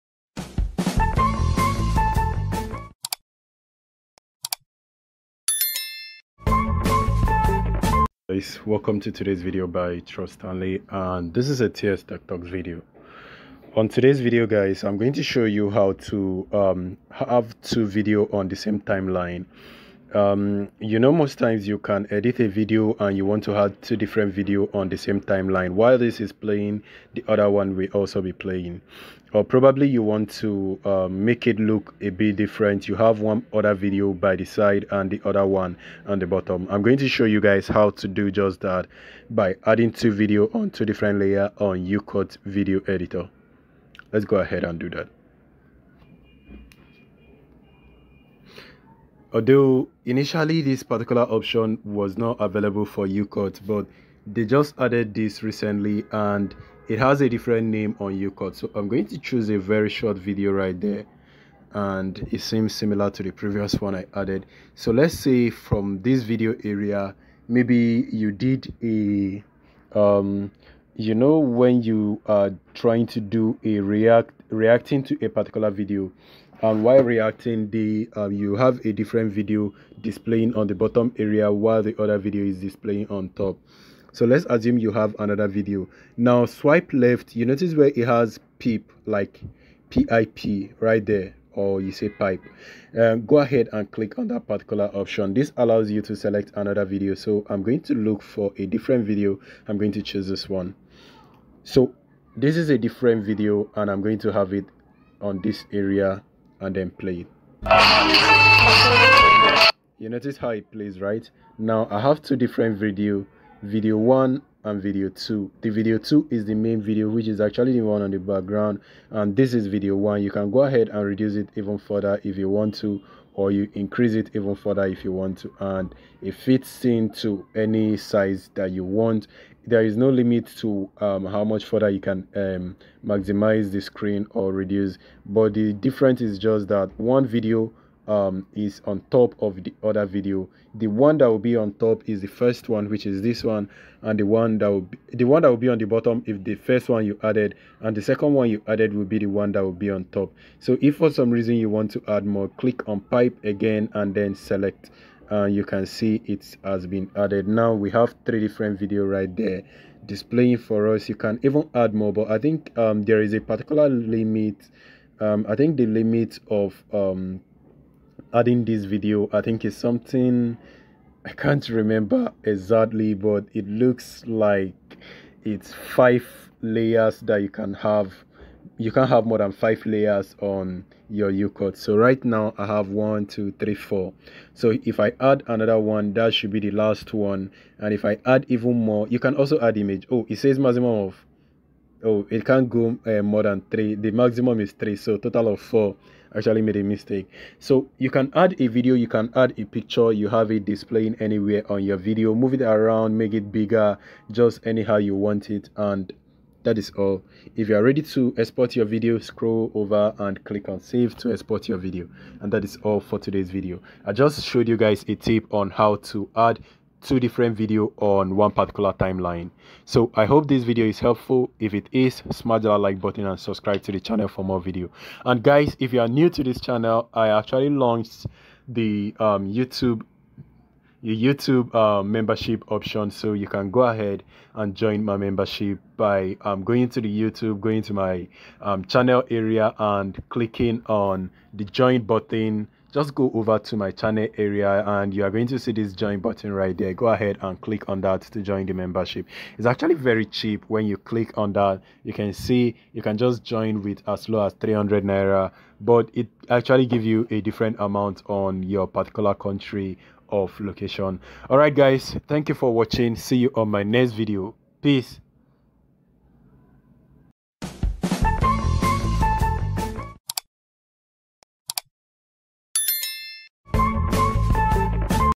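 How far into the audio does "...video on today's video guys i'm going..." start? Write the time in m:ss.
0:12.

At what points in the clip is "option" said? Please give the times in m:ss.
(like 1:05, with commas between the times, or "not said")
0:51, 1:34, 3:52.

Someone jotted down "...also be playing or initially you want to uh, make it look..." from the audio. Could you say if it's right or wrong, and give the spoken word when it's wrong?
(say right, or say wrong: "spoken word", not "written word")
wrong: "probably", not "initially".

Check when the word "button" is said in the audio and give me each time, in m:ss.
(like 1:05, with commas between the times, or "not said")
3:43, 4:02, 4:06.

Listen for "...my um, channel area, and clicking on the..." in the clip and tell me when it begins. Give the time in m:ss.
3:57.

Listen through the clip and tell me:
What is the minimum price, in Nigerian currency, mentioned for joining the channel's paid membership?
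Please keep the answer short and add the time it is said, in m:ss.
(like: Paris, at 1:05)
300 naira, at 4:14.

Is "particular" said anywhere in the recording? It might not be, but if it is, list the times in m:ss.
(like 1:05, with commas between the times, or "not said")
0:50, 1:15, 1:34, 2:43, 3:38, 4:18.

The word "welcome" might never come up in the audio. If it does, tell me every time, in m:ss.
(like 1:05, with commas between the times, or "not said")
0:08.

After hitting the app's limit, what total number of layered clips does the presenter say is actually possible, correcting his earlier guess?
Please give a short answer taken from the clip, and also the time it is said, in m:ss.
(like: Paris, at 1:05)
4, at 3:15.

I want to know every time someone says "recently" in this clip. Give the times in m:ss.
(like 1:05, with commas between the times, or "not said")
0:55.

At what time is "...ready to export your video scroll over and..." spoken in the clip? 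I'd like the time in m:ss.
3:27.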